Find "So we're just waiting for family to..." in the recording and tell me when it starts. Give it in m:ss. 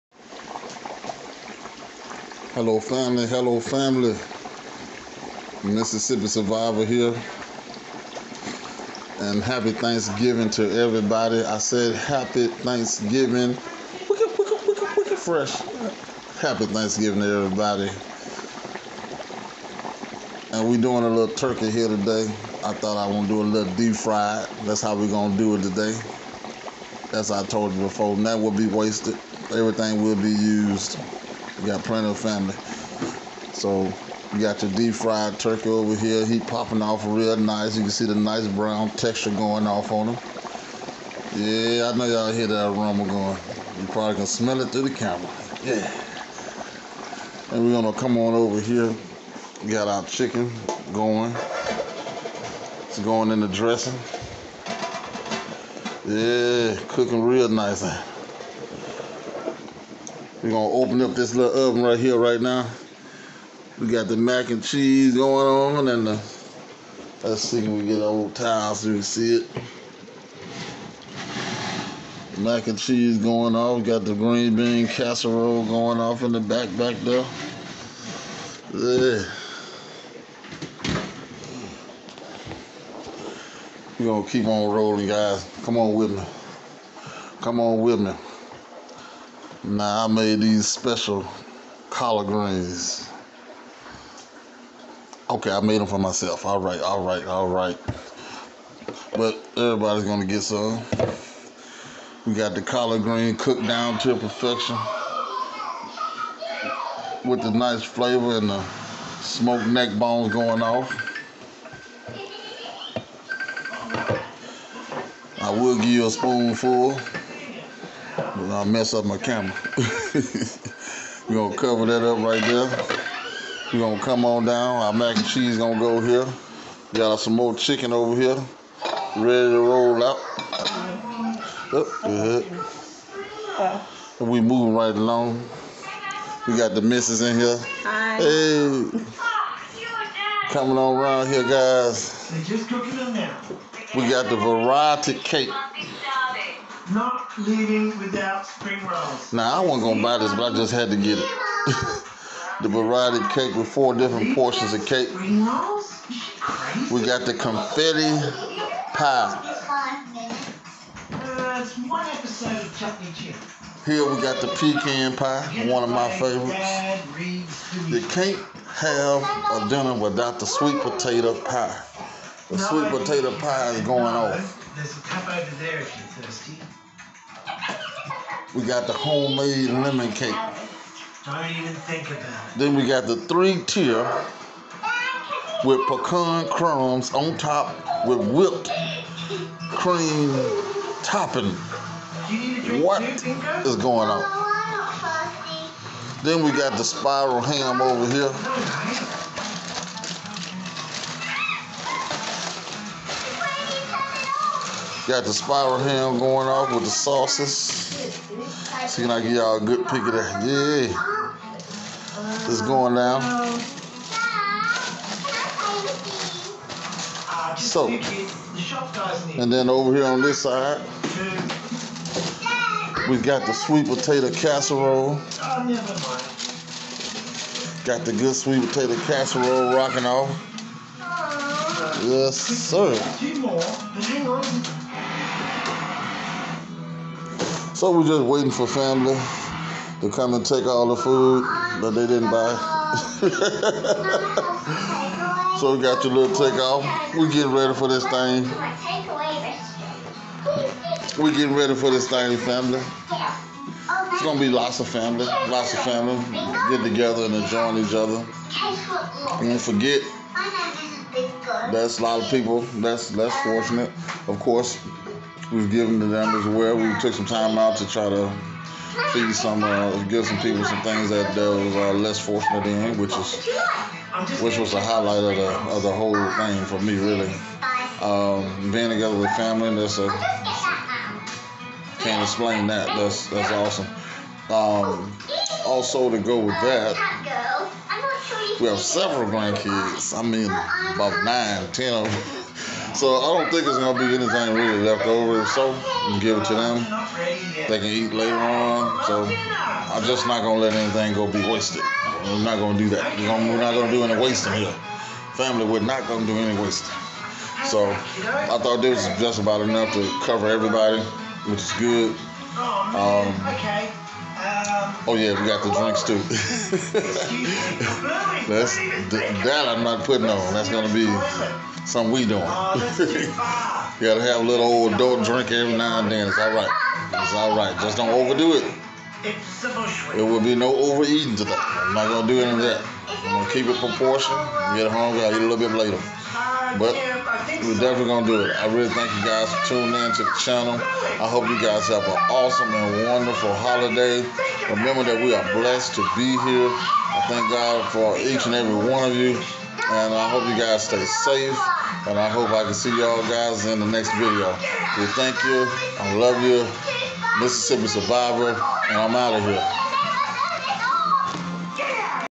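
3:57.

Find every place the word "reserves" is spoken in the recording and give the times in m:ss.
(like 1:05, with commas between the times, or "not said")
not said.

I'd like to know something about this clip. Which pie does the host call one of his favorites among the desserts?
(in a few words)
Pecan pie.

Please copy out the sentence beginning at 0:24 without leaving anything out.
That's how we're going to do it today.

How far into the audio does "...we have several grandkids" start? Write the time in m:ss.
4:48.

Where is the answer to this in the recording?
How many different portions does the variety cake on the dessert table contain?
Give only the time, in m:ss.
2:33.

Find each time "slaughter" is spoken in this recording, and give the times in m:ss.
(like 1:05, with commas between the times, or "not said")
not said.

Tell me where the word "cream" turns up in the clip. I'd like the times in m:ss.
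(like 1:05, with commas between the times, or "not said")
3:09.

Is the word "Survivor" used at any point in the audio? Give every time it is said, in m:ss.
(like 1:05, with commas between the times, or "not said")
0:06, 5:57.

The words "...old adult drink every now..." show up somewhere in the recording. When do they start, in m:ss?
5:24.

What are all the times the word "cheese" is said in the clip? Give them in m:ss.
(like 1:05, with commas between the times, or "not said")
1:04, 1:12, 2:05.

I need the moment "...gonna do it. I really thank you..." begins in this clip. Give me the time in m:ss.
5:38.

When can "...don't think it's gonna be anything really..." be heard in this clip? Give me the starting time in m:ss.
4:53.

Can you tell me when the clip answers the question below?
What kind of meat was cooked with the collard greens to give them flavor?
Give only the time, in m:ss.
1:49.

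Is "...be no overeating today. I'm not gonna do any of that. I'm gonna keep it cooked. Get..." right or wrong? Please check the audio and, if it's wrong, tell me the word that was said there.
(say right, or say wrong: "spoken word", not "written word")
wrong: "proportioned", not "cooked".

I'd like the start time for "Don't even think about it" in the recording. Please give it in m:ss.
3:01.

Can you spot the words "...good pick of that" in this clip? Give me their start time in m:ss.
3:29.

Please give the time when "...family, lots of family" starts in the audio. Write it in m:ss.
4:14.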